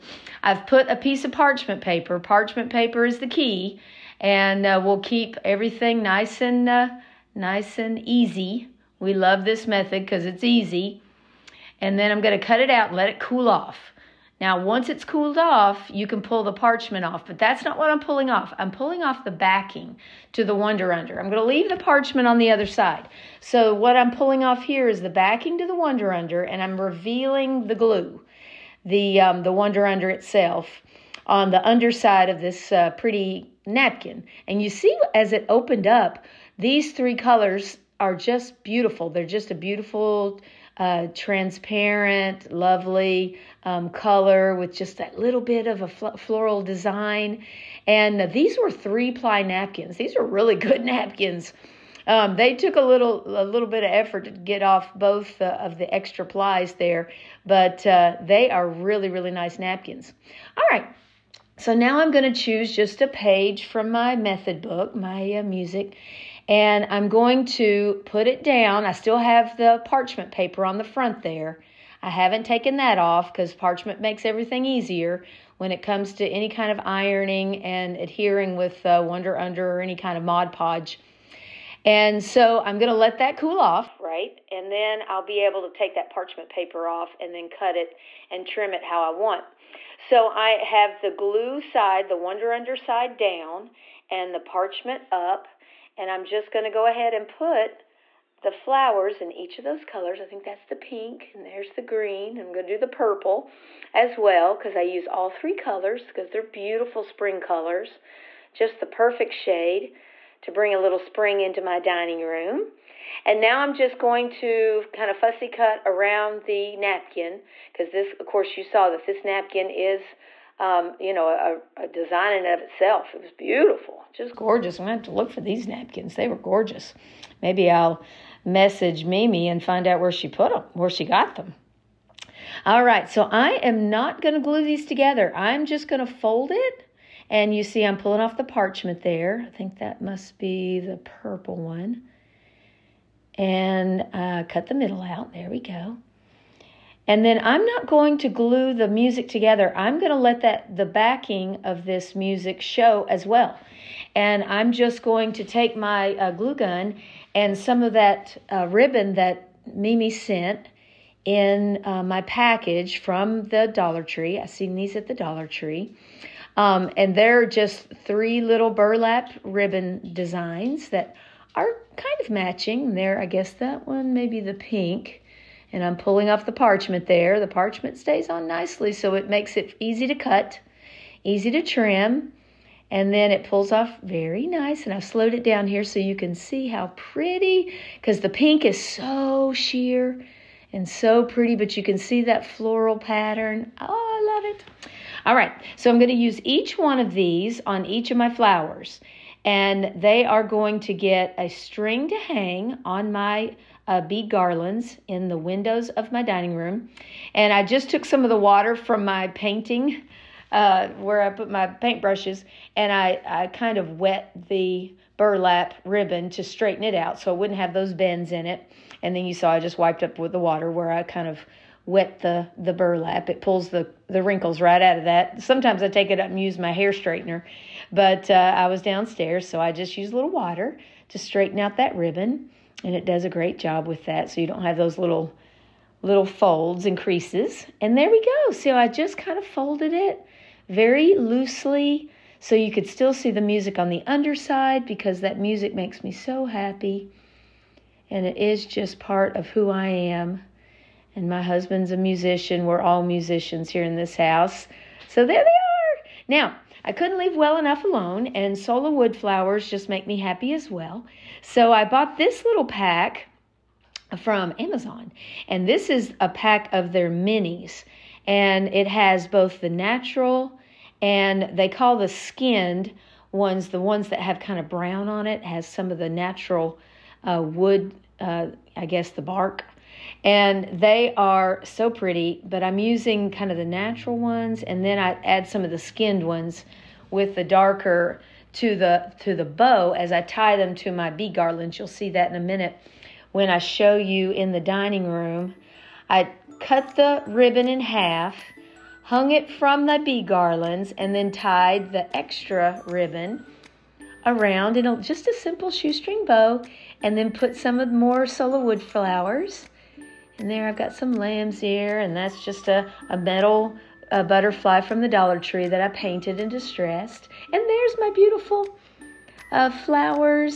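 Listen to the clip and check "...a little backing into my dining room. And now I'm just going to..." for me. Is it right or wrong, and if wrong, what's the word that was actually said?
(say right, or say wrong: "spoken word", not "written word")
wrong: "spring", not "backing".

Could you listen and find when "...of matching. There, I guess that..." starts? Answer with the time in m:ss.
2:52.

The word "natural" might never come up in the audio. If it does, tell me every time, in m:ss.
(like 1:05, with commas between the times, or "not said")
4:29, 4:36, 4:43.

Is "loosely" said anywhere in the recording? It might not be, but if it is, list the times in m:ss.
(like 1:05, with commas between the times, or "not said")
4:01.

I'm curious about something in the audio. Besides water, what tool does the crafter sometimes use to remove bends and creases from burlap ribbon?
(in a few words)
Hair straightener.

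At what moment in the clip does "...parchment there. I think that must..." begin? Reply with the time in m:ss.
2:18.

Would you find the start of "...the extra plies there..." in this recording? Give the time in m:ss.
0:55.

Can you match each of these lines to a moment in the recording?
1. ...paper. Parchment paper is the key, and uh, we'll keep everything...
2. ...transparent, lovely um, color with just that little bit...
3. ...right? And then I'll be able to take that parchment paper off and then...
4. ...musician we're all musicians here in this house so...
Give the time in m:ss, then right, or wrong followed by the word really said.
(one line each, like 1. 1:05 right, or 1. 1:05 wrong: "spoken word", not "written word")
1. 0:01 right
2. 0:41 right
3. 1:23 right
4. 4:11 right.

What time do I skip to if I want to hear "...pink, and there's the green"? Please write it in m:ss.
1:40.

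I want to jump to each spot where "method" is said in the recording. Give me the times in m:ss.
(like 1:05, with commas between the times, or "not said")
0:09, 1:04.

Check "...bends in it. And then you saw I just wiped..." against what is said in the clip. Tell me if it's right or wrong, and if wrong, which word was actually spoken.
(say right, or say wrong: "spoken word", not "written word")
right.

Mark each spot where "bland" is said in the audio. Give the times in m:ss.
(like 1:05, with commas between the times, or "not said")
not said.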